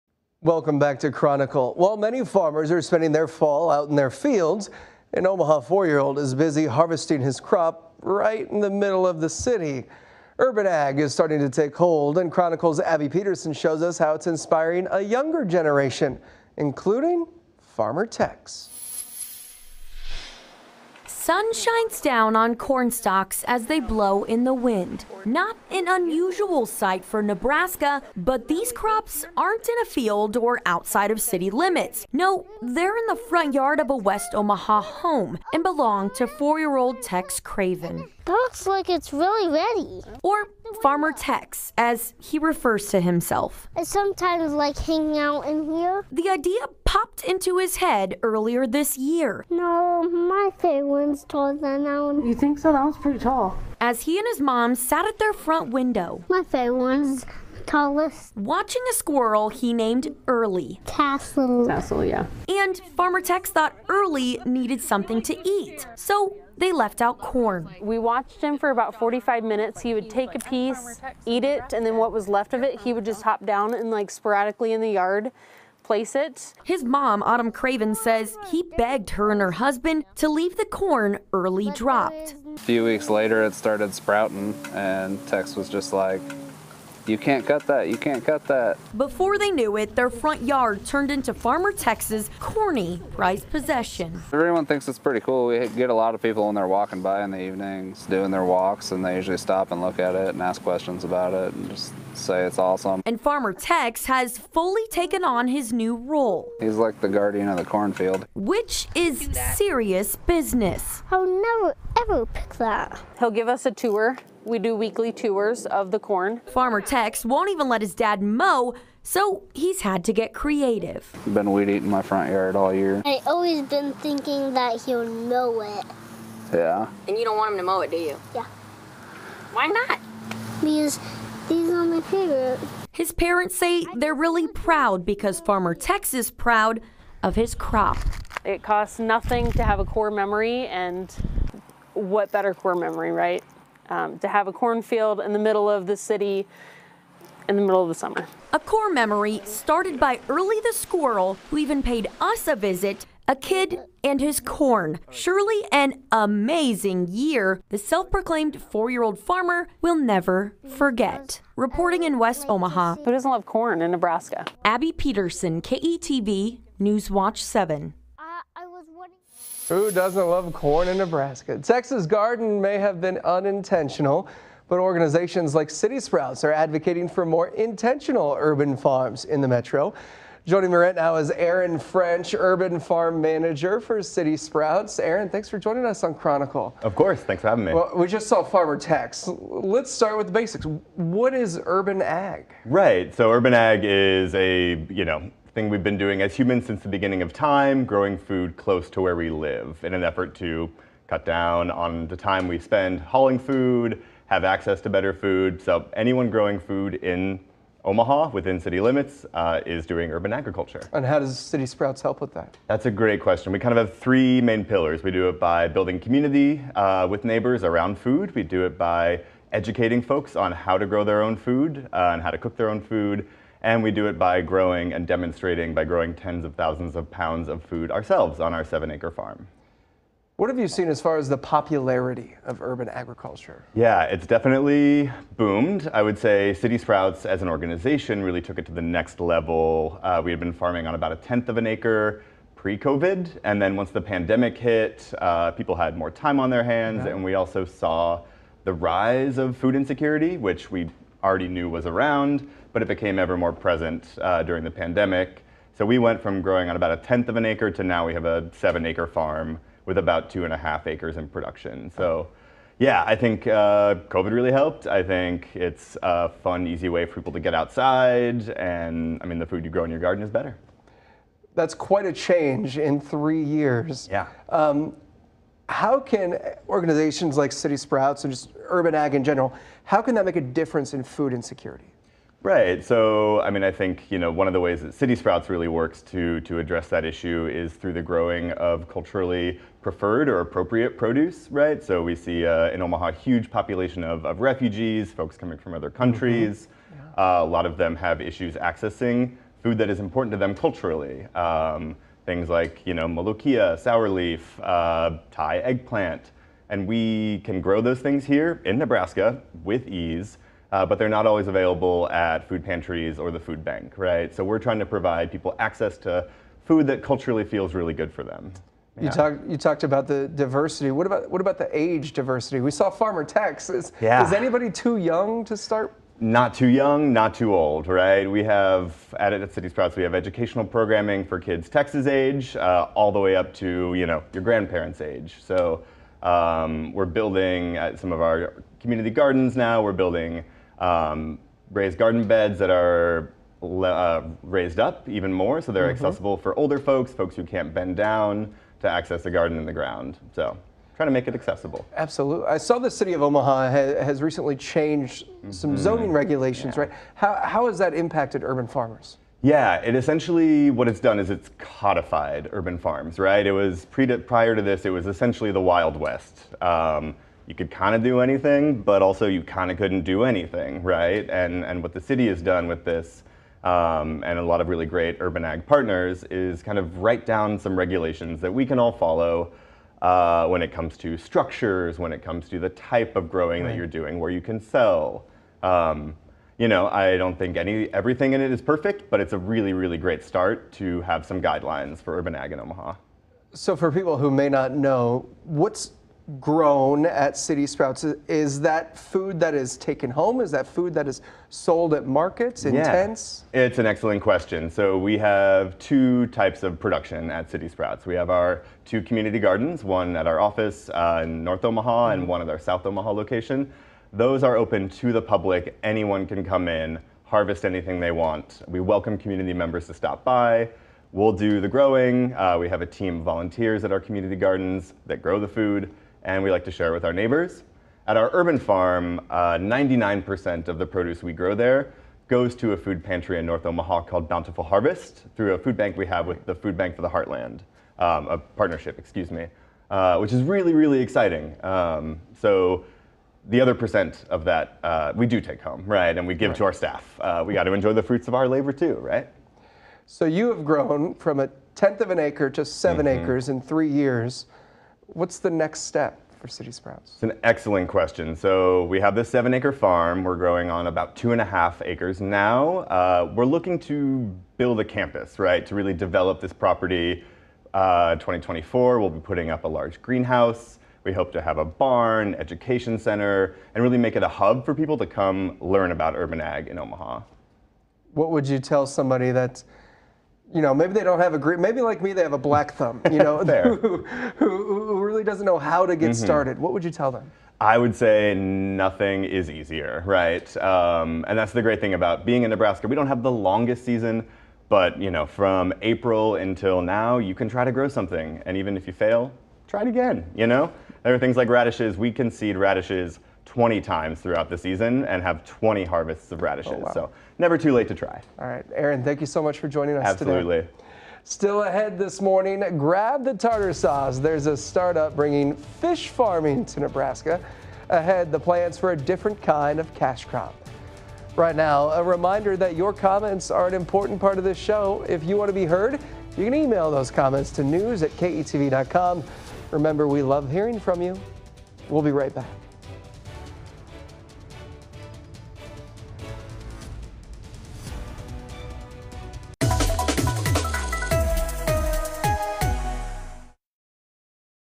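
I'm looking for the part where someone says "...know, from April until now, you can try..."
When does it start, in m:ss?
8:15.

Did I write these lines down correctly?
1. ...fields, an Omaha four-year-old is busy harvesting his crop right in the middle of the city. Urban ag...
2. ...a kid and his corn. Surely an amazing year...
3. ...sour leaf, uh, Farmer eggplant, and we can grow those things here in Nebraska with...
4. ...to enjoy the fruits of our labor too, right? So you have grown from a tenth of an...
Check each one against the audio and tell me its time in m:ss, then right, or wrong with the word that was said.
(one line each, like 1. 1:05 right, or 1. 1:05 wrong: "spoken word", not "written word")
1. 0:04 right
2. 2:33 right
3. 5:03 wrong: "Thai", not "Farmer"
4. 7:27 right.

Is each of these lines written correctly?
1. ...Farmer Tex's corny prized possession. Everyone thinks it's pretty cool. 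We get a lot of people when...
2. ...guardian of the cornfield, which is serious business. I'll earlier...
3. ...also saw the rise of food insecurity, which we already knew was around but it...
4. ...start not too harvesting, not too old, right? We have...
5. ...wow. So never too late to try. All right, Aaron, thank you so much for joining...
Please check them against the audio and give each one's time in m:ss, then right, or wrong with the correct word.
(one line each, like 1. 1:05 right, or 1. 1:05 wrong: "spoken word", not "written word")
1. 1:31 right
2. 1:47 wrong: "never", not "earlier"
3. 4:07 right
4. 5:25 wrong: "young", not "harvesting"
5. 8:26 right.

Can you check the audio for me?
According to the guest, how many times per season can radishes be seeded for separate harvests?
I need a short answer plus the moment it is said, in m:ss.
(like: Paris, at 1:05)
20, at 8:23.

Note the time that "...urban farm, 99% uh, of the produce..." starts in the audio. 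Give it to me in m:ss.
7:08.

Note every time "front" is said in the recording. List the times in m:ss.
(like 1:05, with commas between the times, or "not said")
0:33, 0:55, 1:30, 2:02.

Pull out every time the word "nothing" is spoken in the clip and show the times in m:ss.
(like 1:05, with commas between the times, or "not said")
2:18, 8:08.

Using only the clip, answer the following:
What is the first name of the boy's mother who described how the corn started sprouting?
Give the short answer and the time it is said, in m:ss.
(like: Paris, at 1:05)
Autumn, at 1:17.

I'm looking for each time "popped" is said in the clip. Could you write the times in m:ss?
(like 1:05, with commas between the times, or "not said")
0:46.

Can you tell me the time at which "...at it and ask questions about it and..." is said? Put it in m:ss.
1:39.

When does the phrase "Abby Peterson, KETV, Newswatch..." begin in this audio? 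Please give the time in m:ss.
2:44.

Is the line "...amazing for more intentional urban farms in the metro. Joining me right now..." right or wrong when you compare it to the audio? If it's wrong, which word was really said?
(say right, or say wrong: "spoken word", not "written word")
wrong: "advocating", not "amazing".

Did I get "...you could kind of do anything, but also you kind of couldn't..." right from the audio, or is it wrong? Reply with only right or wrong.
right.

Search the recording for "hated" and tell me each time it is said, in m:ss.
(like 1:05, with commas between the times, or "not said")
not said.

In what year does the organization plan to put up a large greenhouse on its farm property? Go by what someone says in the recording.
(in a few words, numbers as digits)
2024.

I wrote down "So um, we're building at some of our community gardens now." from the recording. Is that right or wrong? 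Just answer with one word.
right.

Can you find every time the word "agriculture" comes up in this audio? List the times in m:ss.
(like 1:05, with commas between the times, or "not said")
3:30, 3:52.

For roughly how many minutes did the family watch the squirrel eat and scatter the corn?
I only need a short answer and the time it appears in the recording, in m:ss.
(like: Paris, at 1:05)
45, at 1:08.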